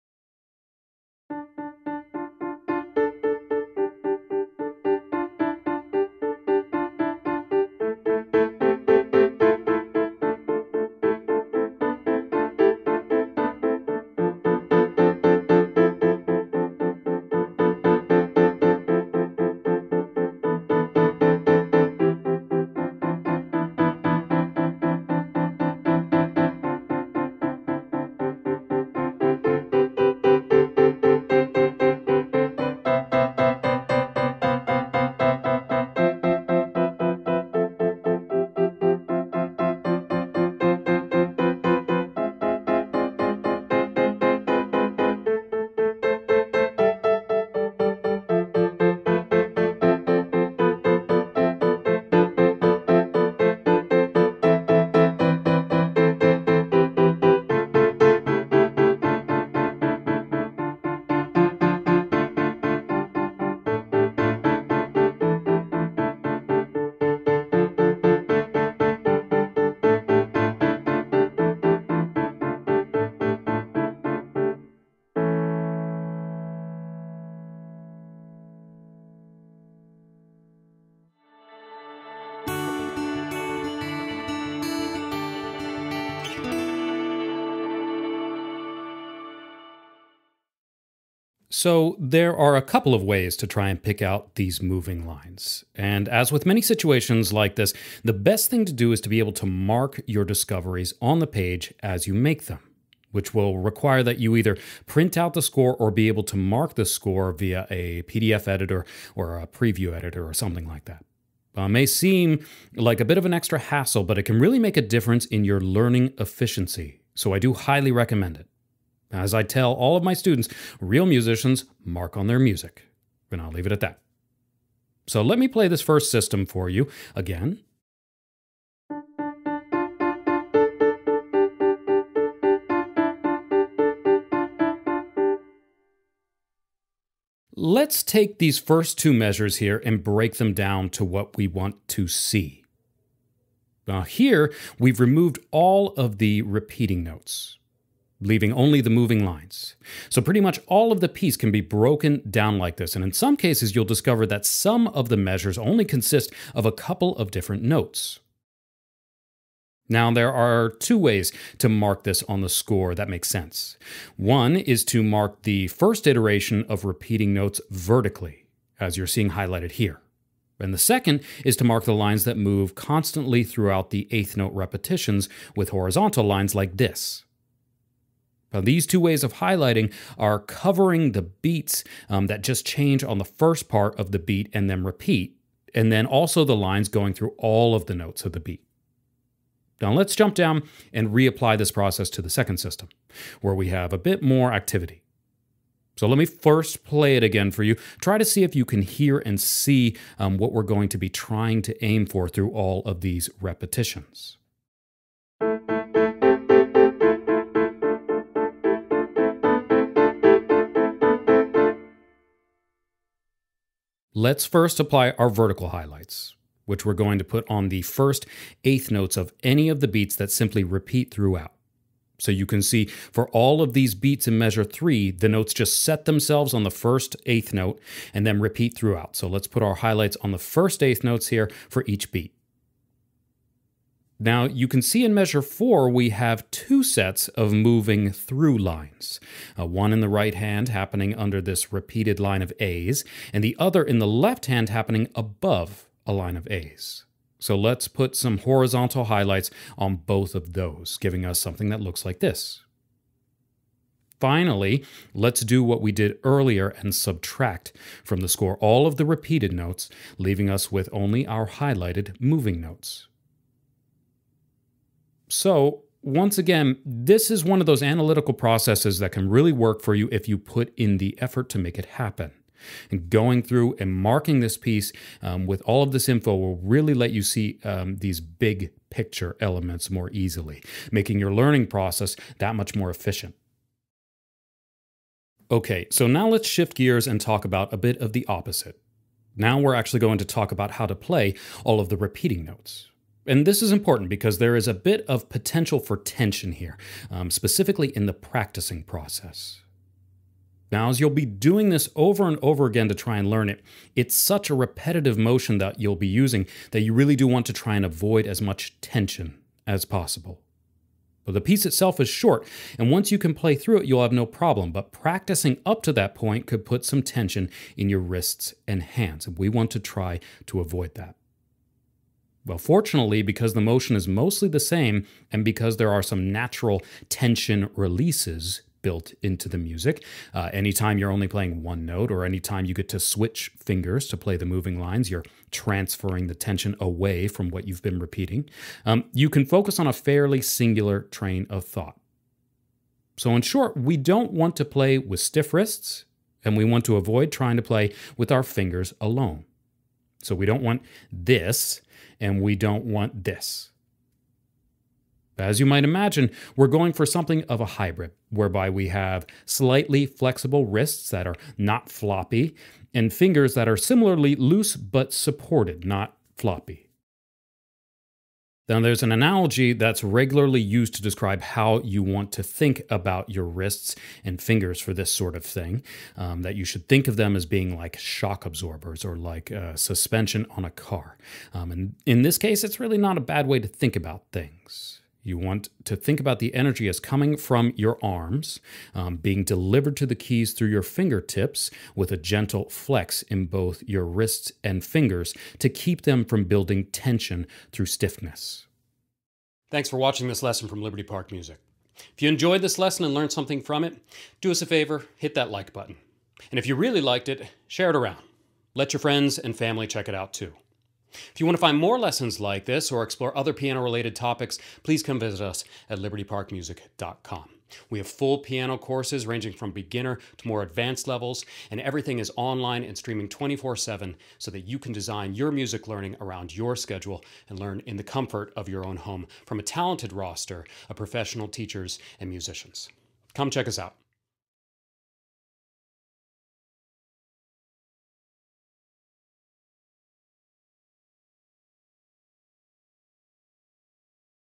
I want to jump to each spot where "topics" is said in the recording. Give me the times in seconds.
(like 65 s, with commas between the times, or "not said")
414 s.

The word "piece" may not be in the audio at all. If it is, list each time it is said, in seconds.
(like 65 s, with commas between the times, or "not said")
151 s, 274 s, 311 s.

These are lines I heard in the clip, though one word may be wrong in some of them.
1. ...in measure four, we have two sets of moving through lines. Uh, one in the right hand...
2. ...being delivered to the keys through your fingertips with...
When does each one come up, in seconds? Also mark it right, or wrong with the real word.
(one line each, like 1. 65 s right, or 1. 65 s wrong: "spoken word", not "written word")
1. 235 s right
2. 389 s right.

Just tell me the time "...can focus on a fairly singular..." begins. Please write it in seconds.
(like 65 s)
339 s.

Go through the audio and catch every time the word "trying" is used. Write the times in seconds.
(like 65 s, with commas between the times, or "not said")
201 s, 347 s.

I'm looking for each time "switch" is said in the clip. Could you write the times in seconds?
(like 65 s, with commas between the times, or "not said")
332 s.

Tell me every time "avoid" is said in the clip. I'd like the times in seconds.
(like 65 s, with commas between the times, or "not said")
307 s, 320 s, 346 s.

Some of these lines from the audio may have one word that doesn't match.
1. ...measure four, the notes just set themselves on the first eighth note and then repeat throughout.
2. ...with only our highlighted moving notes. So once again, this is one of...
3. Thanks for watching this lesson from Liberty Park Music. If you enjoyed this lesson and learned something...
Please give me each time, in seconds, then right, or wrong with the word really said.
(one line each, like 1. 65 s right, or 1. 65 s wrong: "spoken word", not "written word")
1. 224 s wrong: "three", not "four"
2. 260 s right
3. 399 s right.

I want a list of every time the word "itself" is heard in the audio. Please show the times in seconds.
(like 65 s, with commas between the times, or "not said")
311 s.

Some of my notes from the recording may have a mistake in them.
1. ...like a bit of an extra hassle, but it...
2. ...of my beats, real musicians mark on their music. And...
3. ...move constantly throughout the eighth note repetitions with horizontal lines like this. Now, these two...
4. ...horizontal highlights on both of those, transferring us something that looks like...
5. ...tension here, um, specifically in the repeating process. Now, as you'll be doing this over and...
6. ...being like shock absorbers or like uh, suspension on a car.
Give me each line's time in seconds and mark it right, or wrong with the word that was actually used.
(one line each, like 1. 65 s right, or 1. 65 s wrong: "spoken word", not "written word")
1. 112 s right
2. 119 s wrong: "students", not "beats"
3. 172 s right
4. 248 s wrong: "giving", not "transferring"
5. 295 s wrong: "practicing", not "repeating"
6. 377 s right.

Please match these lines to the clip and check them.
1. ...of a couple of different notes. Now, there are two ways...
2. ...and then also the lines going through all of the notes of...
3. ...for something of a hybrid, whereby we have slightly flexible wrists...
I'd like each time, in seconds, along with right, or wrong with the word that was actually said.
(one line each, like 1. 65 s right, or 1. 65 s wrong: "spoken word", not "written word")
1. 156 s right
2. 185 s right
3. 356 s right.